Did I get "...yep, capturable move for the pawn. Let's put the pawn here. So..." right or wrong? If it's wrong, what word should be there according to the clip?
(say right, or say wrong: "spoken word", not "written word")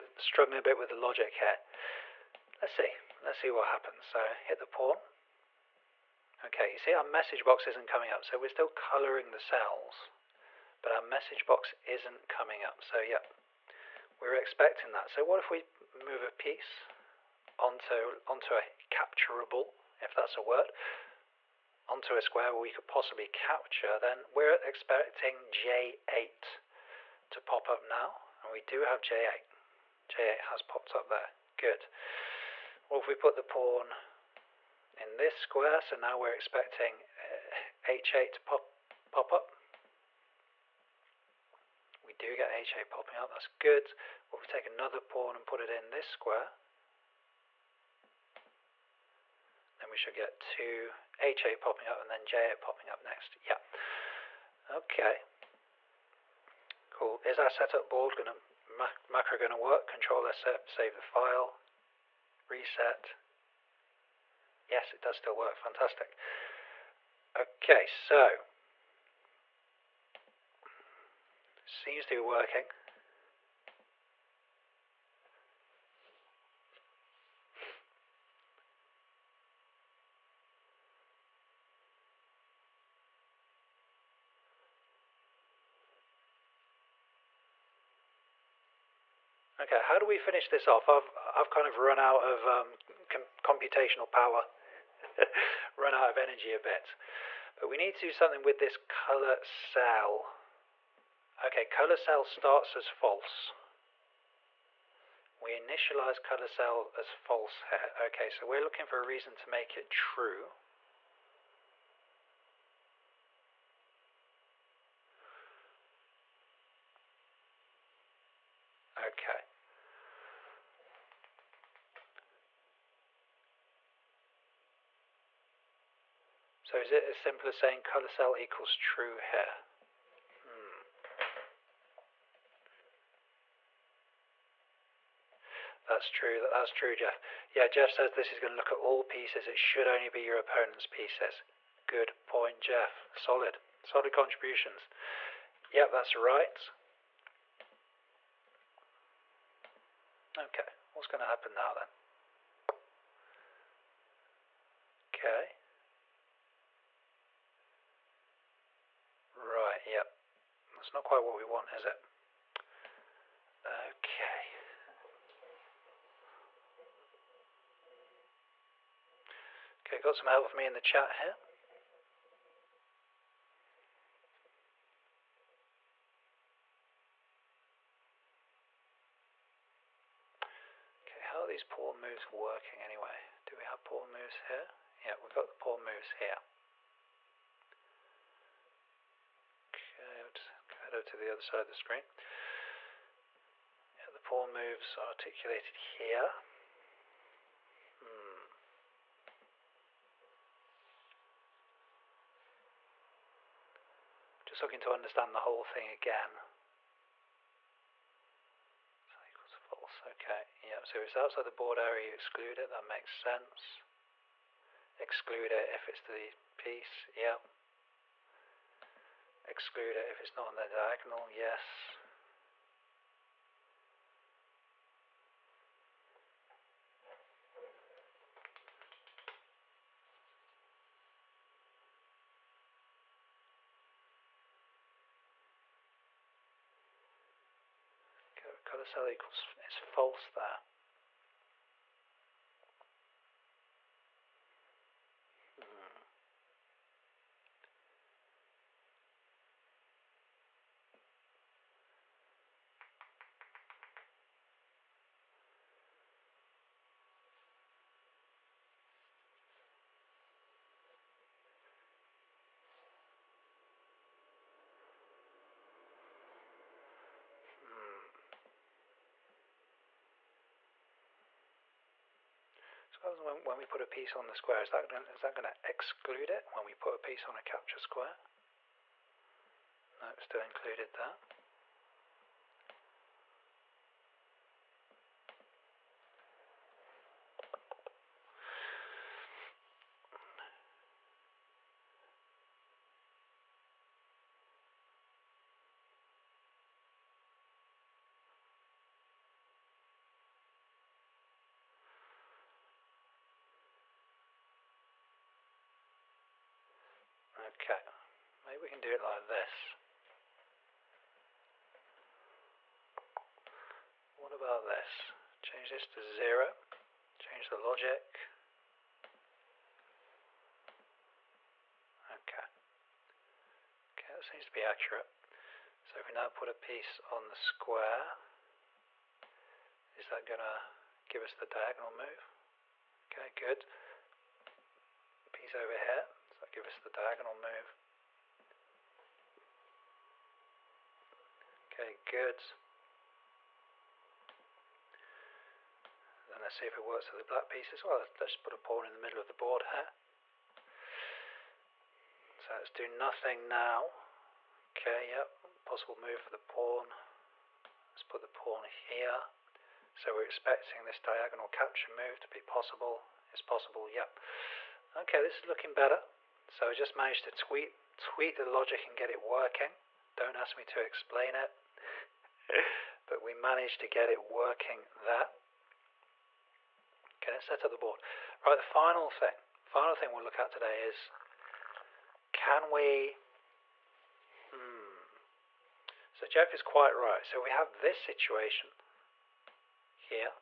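wrong: "possible", not "capturable".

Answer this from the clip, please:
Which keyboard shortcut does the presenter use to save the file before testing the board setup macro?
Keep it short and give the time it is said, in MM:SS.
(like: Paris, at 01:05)
Control S, at 00:59.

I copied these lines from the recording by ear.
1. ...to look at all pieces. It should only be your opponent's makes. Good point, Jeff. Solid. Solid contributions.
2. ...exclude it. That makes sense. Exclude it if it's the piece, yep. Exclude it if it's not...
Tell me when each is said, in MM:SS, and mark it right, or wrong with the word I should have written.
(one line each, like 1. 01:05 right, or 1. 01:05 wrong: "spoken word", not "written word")
1. 02:18 wrong: "pieces", not "makes"
2. 03:32 right.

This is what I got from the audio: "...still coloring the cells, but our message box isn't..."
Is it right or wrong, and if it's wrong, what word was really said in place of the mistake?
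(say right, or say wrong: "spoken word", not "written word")
right.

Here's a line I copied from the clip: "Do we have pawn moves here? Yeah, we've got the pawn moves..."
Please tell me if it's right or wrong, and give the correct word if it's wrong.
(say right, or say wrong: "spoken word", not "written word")
right.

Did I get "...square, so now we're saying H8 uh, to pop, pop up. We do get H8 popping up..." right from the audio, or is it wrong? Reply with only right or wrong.
wrong.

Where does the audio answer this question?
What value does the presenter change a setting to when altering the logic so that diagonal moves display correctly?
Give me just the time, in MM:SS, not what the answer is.
05:16.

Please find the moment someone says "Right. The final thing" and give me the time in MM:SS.
06:18.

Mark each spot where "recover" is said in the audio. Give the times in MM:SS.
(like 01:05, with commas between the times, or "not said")
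not said.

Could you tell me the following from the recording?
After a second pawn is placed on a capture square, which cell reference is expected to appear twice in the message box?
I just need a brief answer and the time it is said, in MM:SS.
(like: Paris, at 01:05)
H8, at 00:50.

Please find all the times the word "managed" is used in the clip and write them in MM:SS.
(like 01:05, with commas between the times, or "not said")
06:06, 06:13.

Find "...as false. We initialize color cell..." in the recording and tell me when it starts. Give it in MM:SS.
01:42.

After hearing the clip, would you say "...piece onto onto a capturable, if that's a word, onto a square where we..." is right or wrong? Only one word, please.
right.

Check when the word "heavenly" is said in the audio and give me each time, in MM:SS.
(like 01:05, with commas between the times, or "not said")
not said.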